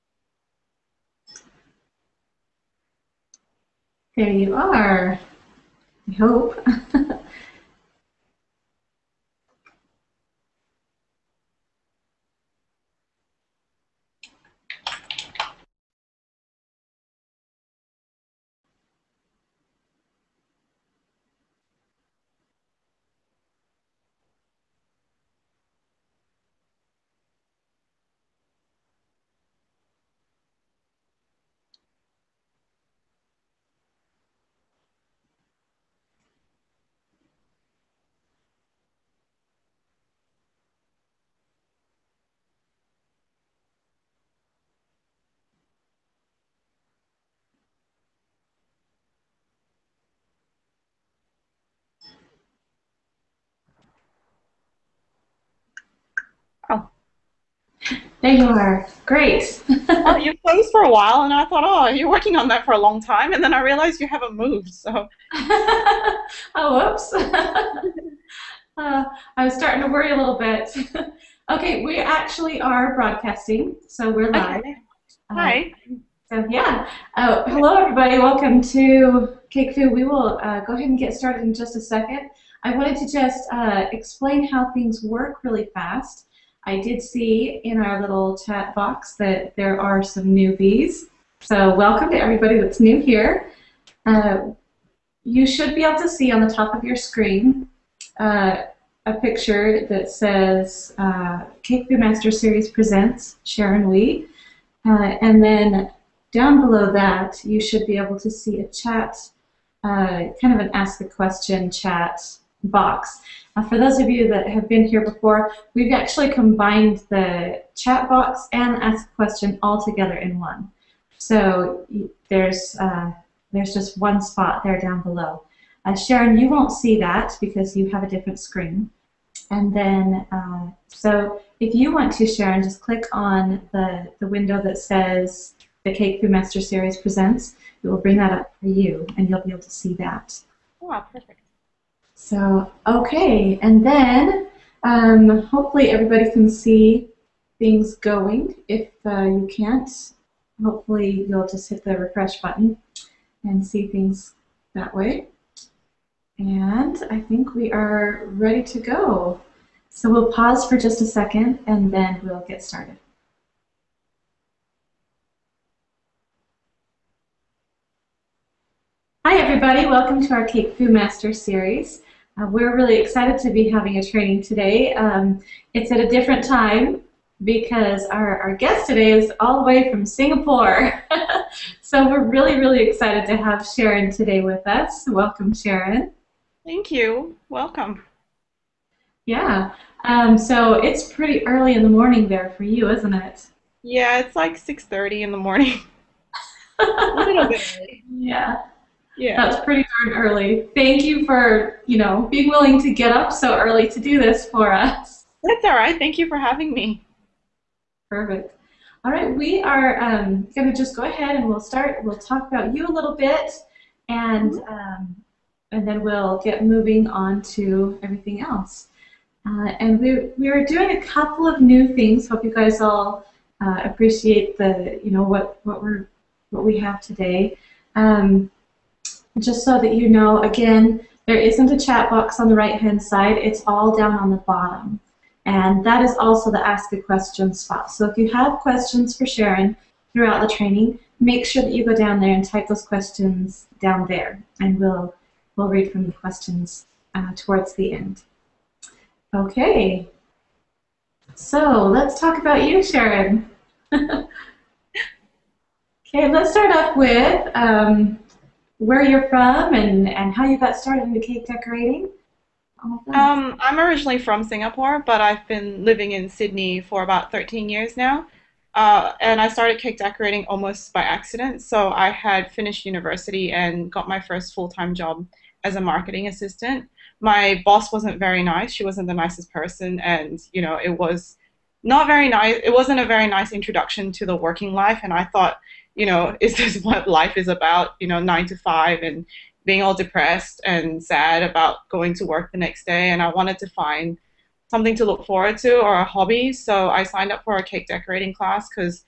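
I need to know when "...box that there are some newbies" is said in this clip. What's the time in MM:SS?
01:28.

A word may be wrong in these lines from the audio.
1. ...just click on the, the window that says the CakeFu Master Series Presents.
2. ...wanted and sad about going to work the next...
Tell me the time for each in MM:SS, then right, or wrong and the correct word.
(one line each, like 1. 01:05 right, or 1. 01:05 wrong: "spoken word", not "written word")
1. 02:12 right
2. 04:49 wrong: "depressed", not "wanted".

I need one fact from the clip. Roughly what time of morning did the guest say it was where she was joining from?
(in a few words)
6.30.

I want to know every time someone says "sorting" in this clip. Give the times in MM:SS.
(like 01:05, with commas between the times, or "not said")
not said.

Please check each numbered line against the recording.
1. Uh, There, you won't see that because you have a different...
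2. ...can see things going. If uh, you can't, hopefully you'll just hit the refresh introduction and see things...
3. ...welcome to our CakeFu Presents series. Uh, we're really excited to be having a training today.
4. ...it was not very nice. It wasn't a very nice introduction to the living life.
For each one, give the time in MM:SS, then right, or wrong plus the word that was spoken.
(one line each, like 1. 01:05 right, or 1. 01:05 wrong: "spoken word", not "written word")
1. 02:05 wrong: "Sharon", not "There"
2. 02:26 wrong: "button", not "introduction"
3. 02:49 wrong: "Master", not "Presents"
4. 04:40 wrong: "working", not "living".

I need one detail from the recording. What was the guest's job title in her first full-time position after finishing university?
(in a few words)
Marketing assistant.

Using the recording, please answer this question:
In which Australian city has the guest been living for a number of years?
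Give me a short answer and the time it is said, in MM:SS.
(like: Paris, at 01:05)
Sydney, at 04:26.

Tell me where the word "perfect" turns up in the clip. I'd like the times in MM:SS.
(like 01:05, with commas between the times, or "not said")
02:21, 03:28.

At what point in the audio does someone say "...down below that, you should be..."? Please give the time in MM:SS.
01:46.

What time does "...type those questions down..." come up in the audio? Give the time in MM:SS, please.
04:02.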